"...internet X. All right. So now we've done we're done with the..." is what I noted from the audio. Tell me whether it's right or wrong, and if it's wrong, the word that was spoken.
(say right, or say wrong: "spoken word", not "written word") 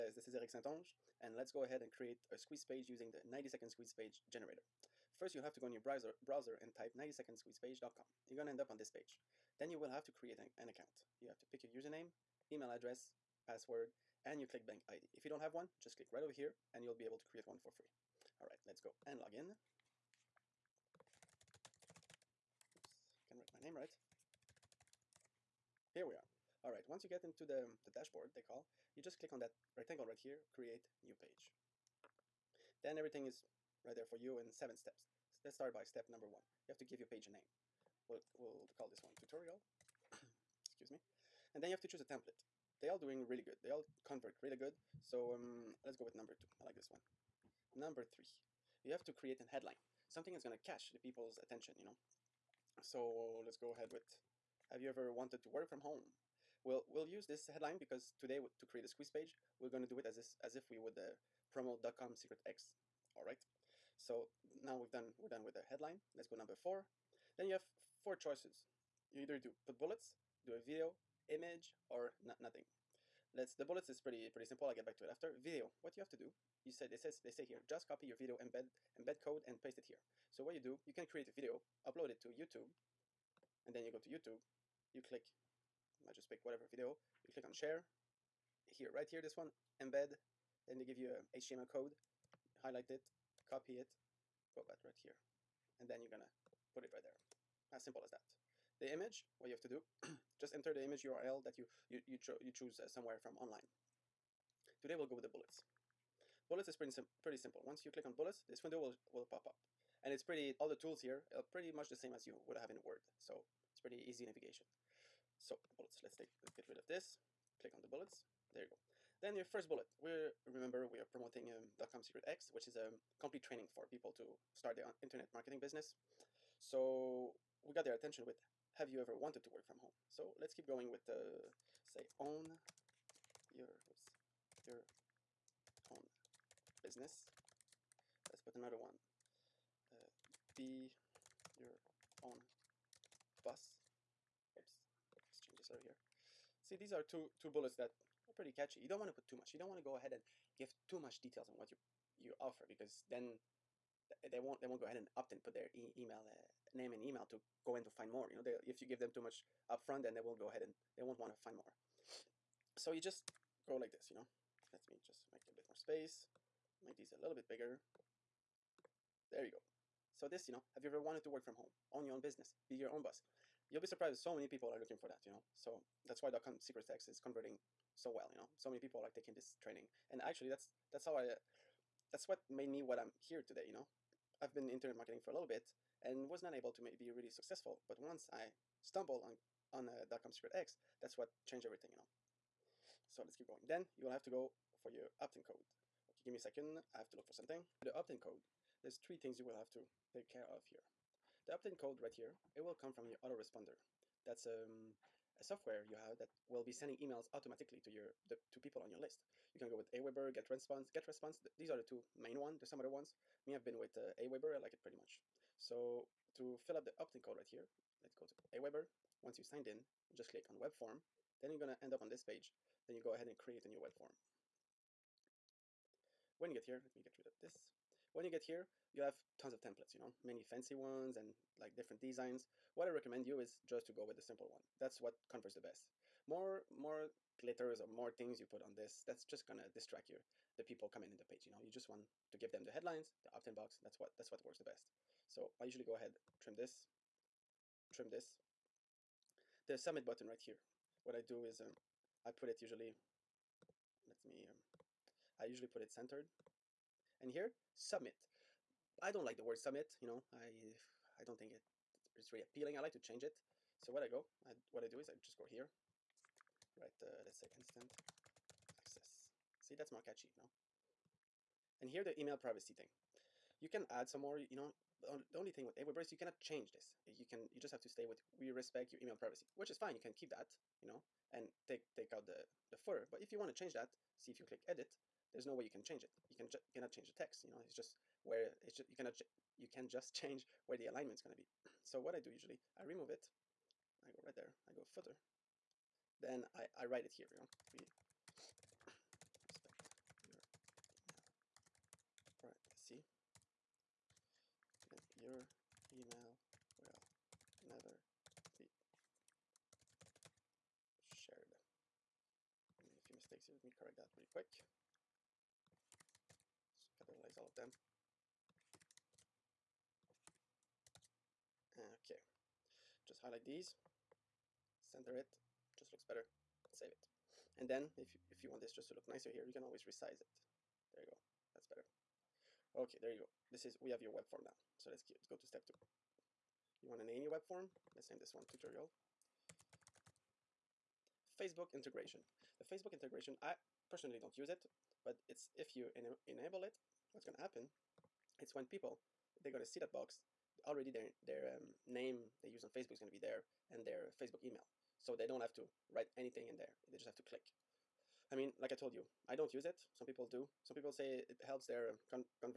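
wrong: "secret", not "internet".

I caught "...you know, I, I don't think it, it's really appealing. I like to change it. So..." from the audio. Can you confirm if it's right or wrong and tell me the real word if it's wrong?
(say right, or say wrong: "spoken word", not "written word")
right.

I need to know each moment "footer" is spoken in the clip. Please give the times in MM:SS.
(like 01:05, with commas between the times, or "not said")
04:42, 04:54.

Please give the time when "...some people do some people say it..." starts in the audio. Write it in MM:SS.
05:59.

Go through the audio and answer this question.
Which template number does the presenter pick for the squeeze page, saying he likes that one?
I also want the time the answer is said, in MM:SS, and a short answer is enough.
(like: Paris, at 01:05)
2, at 00:45.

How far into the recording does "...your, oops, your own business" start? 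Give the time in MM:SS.
02:13.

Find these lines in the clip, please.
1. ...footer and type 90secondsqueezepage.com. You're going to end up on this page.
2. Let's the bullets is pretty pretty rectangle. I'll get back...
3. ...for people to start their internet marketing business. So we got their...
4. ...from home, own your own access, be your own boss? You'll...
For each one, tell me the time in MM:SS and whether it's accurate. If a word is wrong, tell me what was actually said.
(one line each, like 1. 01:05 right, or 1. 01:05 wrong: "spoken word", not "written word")
1. 00:06 wrong: "browser", not "footer"
2. 01:13 wrong: "simple", not "rectangle"
3. 02:03 right
4. 02:51 wrong: "business", not "access".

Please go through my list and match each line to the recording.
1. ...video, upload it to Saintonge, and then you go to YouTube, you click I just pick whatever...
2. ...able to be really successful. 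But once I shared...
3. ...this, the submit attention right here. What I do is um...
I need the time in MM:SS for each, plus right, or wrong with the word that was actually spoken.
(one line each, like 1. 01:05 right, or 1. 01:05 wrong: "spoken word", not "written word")
1. 01:21 wrong: "YouTube", not "Saintonge"
2. 03:06 wrong: "stumbled", not "shared"
3. 04:08 wrong: "button", not "attention".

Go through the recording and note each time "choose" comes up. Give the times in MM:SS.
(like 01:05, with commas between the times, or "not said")
00:41, 01:42.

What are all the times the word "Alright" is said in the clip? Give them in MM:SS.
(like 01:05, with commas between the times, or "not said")
00:18, 05:02.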